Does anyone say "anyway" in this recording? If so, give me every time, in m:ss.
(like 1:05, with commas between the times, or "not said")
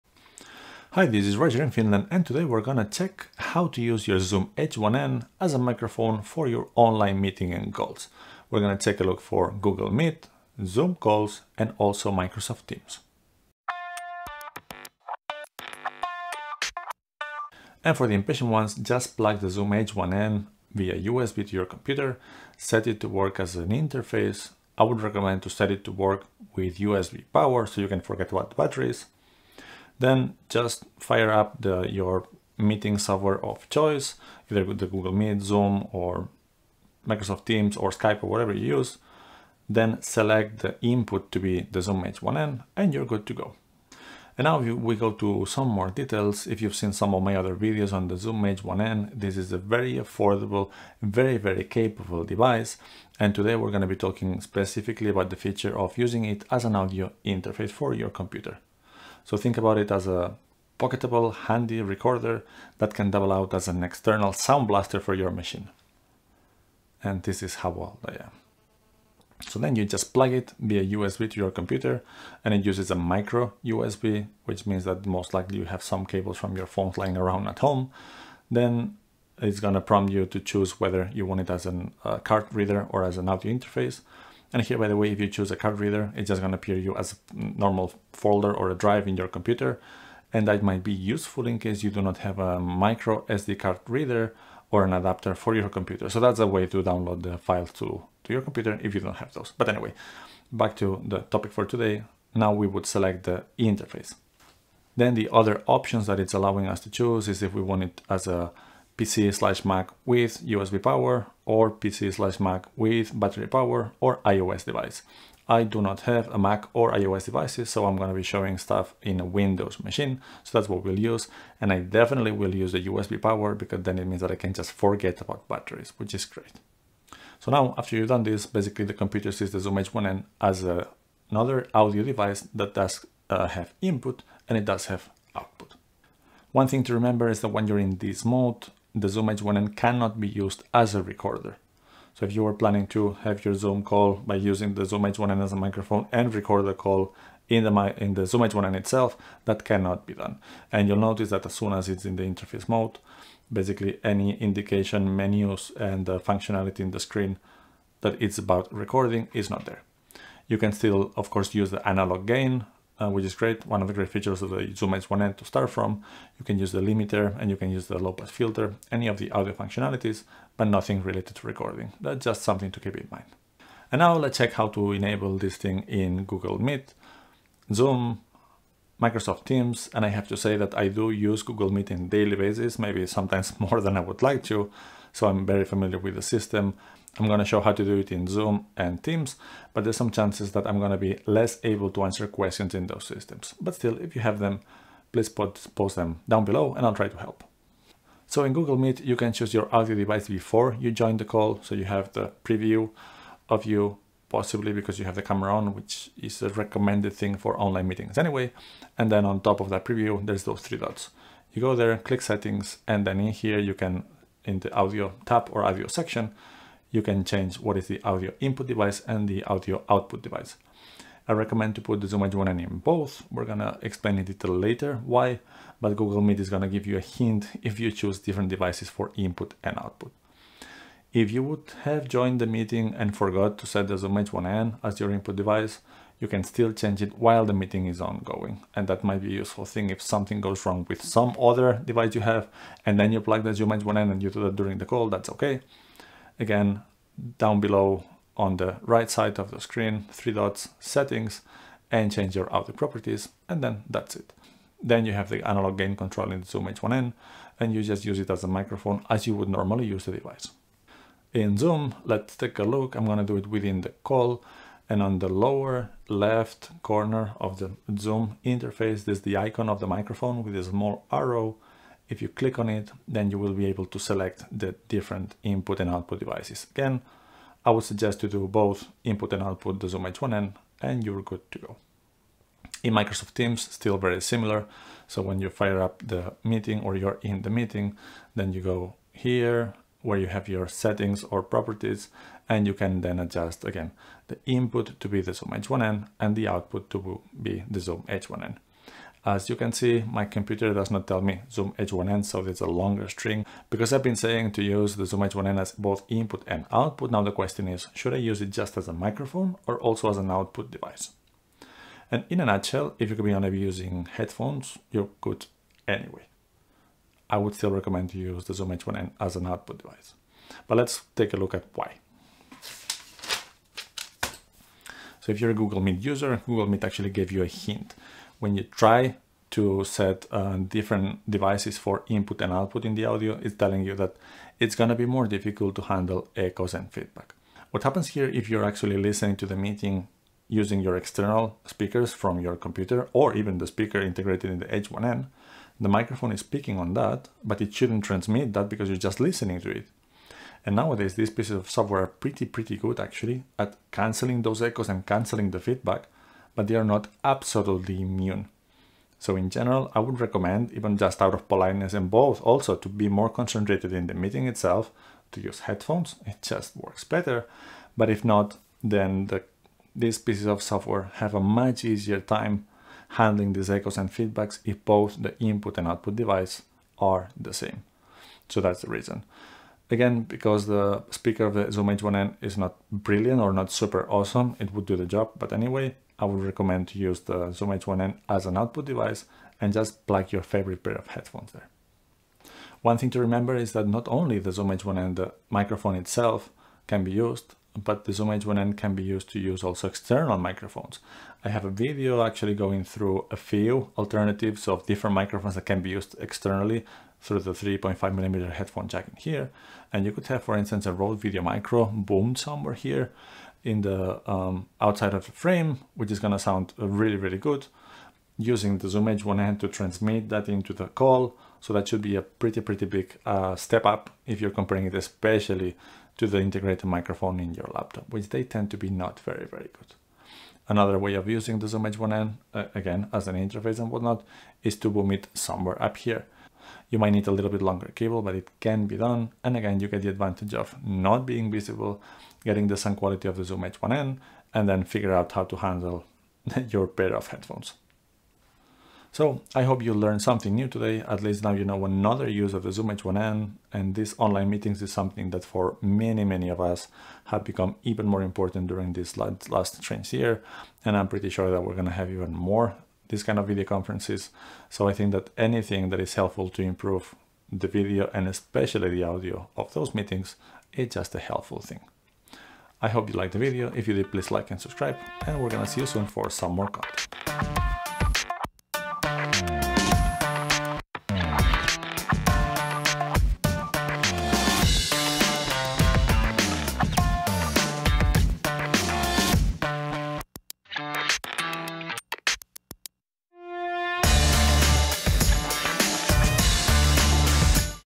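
1:39, 3:28, 5:15, 6:25.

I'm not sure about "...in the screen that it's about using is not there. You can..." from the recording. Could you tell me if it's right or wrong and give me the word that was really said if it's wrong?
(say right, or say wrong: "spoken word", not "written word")
wrong: "recording", not "using".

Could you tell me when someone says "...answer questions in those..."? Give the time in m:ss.
3:12.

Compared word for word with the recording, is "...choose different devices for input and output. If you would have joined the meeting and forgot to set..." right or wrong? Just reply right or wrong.
right.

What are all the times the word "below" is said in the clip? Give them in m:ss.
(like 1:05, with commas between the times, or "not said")
3:16, 4:07.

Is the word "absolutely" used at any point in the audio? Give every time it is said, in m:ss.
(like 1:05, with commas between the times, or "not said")
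5:57.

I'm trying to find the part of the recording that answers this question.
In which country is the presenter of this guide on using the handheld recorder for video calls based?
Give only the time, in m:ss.
0:01.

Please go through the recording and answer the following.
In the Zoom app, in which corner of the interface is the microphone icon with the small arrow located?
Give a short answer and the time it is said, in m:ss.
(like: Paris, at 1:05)
Lower left, at 4:25.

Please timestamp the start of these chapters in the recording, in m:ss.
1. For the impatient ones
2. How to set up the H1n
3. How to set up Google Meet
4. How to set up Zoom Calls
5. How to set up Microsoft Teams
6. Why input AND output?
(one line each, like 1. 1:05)
1. 0:17
2. 1:10
3. 3:18
4. 4:20
5. 4:42
6. 5:03.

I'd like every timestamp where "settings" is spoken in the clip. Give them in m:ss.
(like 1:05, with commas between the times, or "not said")
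3:32, 4:10, 4:50.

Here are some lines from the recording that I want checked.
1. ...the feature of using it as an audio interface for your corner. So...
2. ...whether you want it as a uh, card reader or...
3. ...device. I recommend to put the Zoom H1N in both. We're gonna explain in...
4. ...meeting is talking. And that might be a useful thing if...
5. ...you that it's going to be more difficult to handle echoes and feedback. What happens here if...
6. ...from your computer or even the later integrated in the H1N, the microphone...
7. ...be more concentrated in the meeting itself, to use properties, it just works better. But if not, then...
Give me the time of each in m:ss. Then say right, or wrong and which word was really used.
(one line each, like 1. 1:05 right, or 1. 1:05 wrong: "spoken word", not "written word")
1. 0:55 wrong: "computer", not "corner"
2. 1:20 right
3. 3:40 right
4. 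3:57 wrong: "ongoing", not "talking"
5. 5:33 right
6. 5:42 wrong: "speaker", not "later"
7. 6:02 wrong: "headphones", not "properties".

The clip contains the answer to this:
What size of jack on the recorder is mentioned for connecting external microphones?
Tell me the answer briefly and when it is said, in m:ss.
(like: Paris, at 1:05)
3.5 millimeter, at 6:47.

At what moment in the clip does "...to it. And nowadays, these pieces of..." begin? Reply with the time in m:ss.
5:49.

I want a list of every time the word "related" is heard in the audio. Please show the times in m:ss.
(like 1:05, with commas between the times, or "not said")
2:51.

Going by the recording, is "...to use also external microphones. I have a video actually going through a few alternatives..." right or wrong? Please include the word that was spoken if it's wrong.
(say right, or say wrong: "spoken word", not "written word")
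right.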